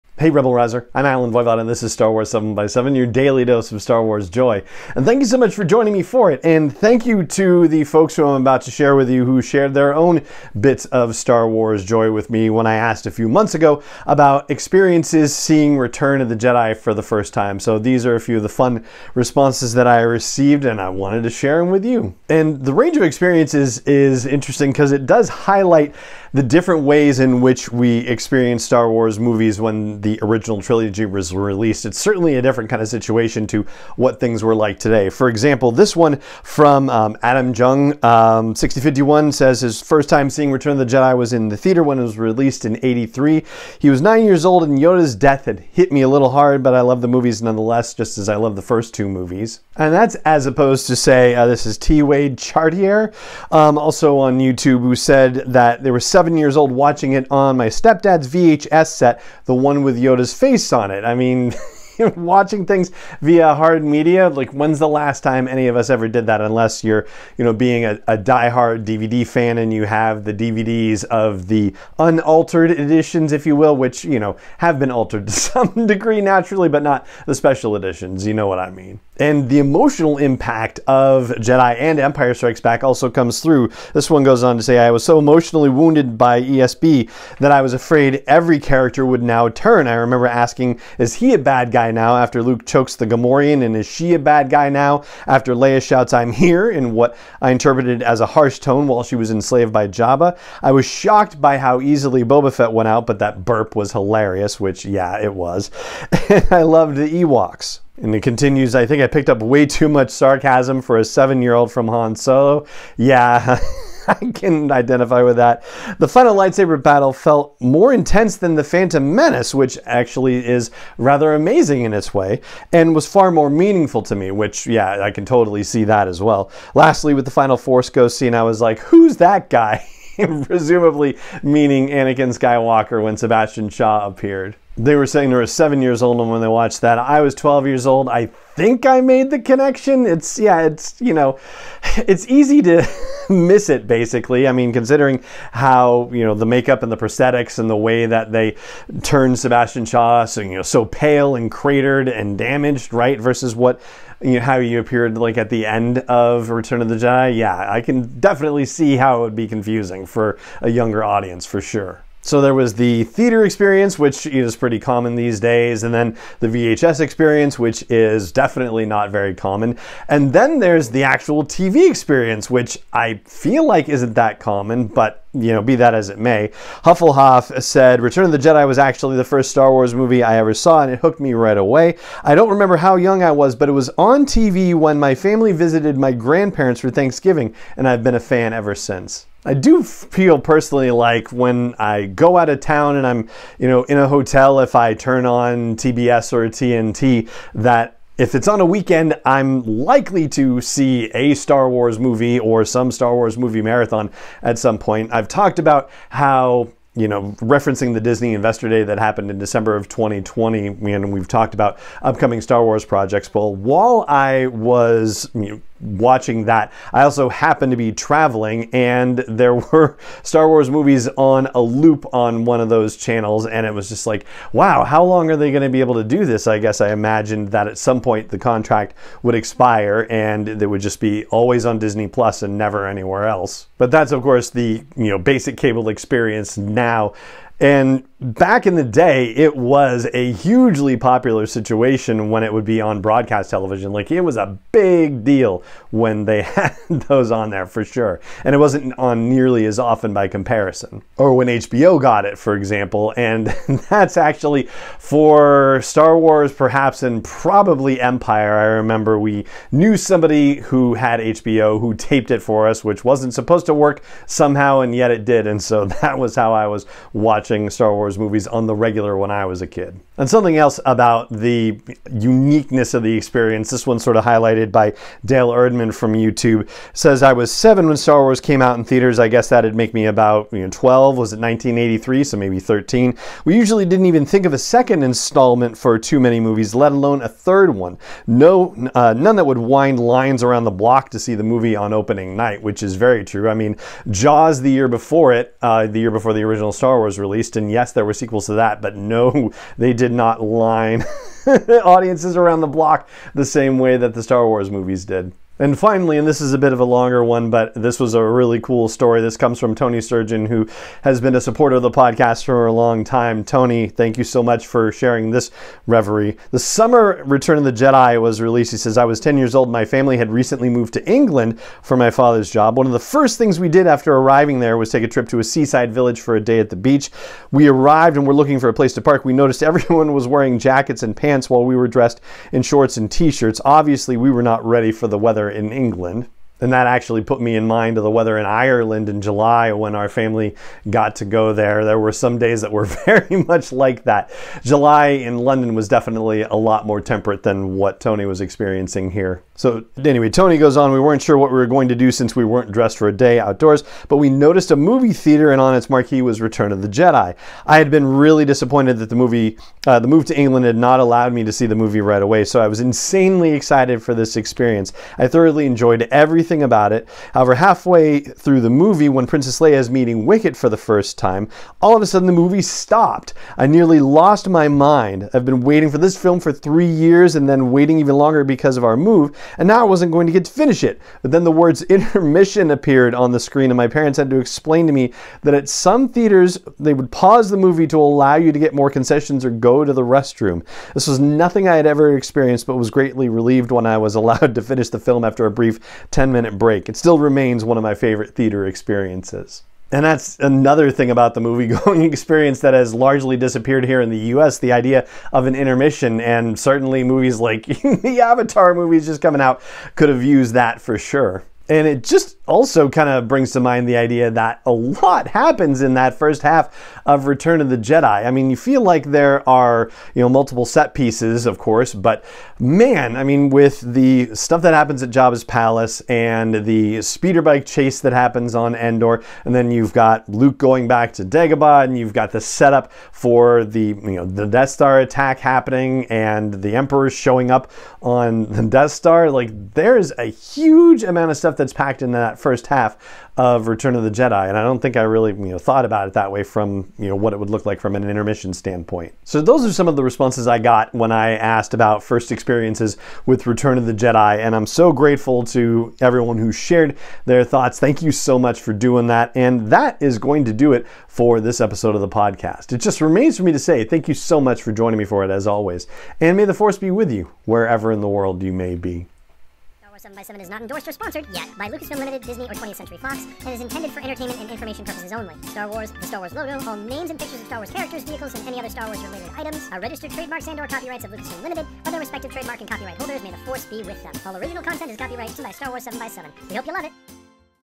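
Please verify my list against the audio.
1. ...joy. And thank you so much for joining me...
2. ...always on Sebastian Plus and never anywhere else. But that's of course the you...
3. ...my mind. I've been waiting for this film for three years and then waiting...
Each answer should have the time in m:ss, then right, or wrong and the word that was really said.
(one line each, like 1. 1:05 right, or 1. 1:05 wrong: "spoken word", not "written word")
1. 0:04 right
2. 3:51 wrong: "Disney", not "Sebastian"
3. 6:14 right.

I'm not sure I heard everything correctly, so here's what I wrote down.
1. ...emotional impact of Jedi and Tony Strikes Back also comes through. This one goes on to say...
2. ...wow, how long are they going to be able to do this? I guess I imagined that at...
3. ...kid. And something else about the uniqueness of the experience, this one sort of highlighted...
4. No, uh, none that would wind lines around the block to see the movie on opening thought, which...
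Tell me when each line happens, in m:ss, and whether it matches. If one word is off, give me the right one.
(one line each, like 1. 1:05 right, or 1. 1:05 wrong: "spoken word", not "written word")
1. 1:19 wrong: "Empire", not "Tony"
2. 3:44 right
3. 4:29 right
4. 4:48 wrong: "night", not "thought".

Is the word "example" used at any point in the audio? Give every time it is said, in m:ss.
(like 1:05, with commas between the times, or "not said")
0:35, 4:12.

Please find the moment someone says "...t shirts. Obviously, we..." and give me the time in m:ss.
5:33.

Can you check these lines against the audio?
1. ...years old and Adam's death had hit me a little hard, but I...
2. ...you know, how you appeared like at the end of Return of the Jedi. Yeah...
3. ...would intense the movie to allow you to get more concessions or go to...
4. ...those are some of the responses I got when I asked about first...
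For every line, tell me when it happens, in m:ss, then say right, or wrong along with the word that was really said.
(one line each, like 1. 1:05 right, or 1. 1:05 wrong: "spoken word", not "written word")
1. 0:44 wrong: "Yoda", not "Adam"
2. 2:34 right
3. 6:26 wrong: "pause", not "intense"
4. 7:29 right.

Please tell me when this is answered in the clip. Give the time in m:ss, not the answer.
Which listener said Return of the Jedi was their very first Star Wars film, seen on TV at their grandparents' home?
2:56.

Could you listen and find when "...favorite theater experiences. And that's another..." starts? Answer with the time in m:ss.
6:37.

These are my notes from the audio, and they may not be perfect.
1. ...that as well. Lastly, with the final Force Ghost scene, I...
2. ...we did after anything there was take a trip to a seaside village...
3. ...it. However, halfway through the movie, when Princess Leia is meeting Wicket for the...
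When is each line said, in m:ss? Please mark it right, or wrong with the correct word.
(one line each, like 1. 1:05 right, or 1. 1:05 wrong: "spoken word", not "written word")
1. 2:05 right
2. 5:23 wrong: "arriving", not "anything"
3. 6:06 right.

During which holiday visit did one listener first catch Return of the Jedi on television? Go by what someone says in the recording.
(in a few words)
Thanksgiving.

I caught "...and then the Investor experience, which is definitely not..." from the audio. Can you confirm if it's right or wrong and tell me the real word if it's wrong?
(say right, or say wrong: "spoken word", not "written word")
wrong: "VHS", not "Investor".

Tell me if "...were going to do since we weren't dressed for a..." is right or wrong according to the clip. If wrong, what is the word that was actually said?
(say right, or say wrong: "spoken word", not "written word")
right.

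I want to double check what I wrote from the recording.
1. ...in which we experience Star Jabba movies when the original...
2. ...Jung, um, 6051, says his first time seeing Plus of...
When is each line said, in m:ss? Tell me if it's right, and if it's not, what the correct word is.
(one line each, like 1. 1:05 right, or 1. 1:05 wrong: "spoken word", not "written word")
1. 0:27 wrong: "Wars", not "Jabba"
2. 0:37 wrong: "Return", not "Plus".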